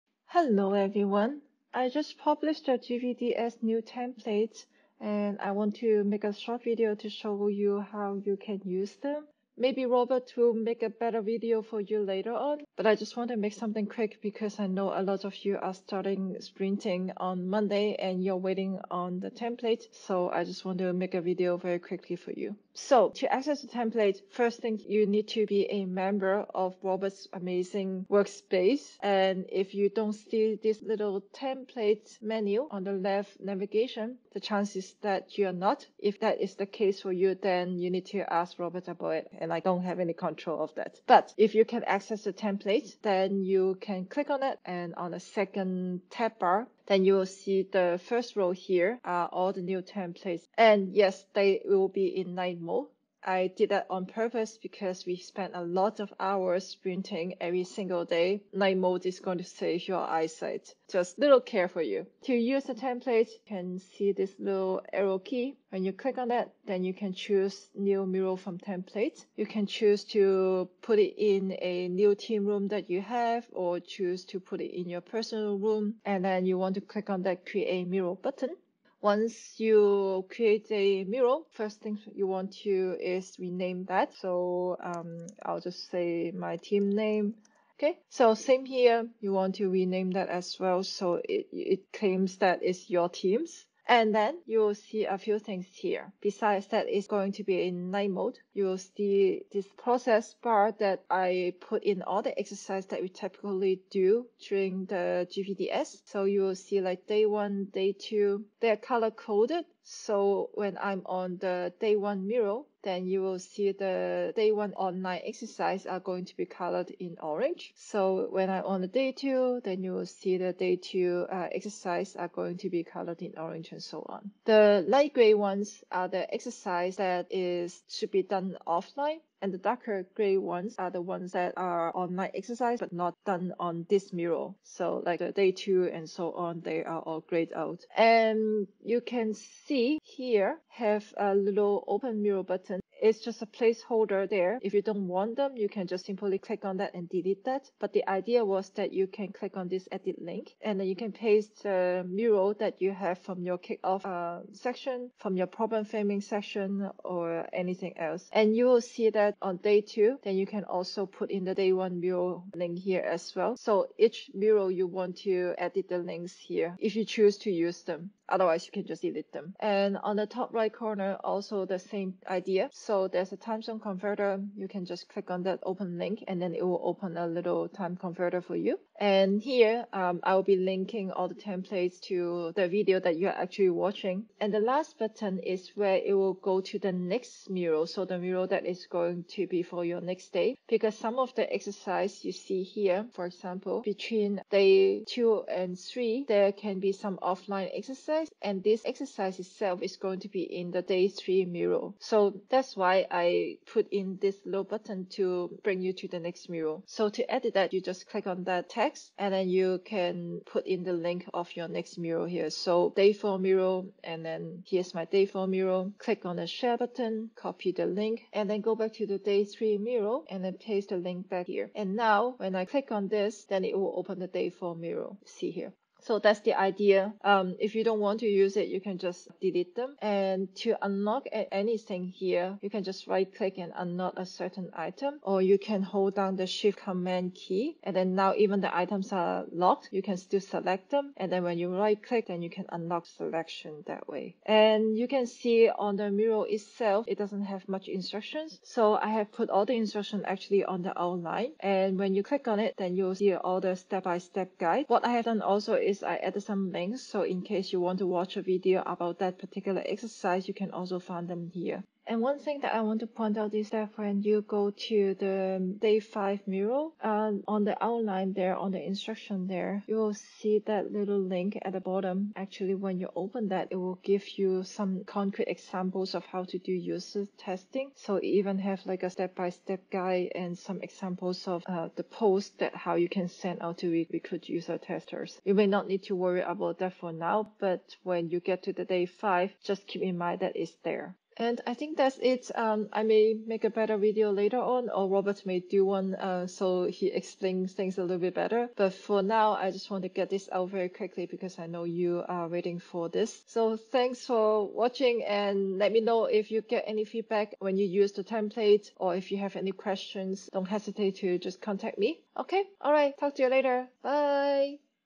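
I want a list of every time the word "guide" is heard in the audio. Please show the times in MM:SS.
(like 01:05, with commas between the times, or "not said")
04:14, 04:39.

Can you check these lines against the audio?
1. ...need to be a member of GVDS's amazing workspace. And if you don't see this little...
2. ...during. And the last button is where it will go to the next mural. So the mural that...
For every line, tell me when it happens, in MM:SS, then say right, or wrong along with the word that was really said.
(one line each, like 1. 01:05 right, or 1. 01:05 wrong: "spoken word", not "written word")
1. 00:25 wrong: "Robert", not "GVDS"
2. 03:03 wrong: "watching", not "during".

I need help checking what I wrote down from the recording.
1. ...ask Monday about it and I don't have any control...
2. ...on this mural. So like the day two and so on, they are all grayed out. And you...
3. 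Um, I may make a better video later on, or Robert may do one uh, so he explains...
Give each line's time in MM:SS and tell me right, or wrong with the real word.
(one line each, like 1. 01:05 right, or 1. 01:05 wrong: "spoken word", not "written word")
1. 00:38 wrong: "Robert", not "Monday"
2. 02:13 right
3. 04:52 right.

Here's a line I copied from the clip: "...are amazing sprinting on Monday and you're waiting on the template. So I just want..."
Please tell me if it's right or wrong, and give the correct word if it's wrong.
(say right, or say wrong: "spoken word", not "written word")
wrong: "starting", not "amazing".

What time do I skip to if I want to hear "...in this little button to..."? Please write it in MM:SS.
03:23.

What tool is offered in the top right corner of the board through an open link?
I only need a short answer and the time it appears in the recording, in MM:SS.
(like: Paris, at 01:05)
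Time zone converter, at 02:53.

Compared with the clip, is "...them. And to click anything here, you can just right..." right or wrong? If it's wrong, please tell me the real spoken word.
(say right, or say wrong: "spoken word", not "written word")
wrong: "unlock", not "click".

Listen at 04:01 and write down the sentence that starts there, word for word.
And then when you right click, then you can unlock selection that way.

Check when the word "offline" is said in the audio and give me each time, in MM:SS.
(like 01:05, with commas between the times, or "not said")
02:08, 03:17.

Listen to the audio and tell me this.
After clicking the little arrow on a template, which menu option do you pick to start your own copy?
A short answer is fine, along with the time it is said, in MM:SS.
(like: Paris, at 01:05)
New mural from template, at 01:07.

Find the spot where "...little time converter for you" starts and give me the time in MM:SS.
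02:57.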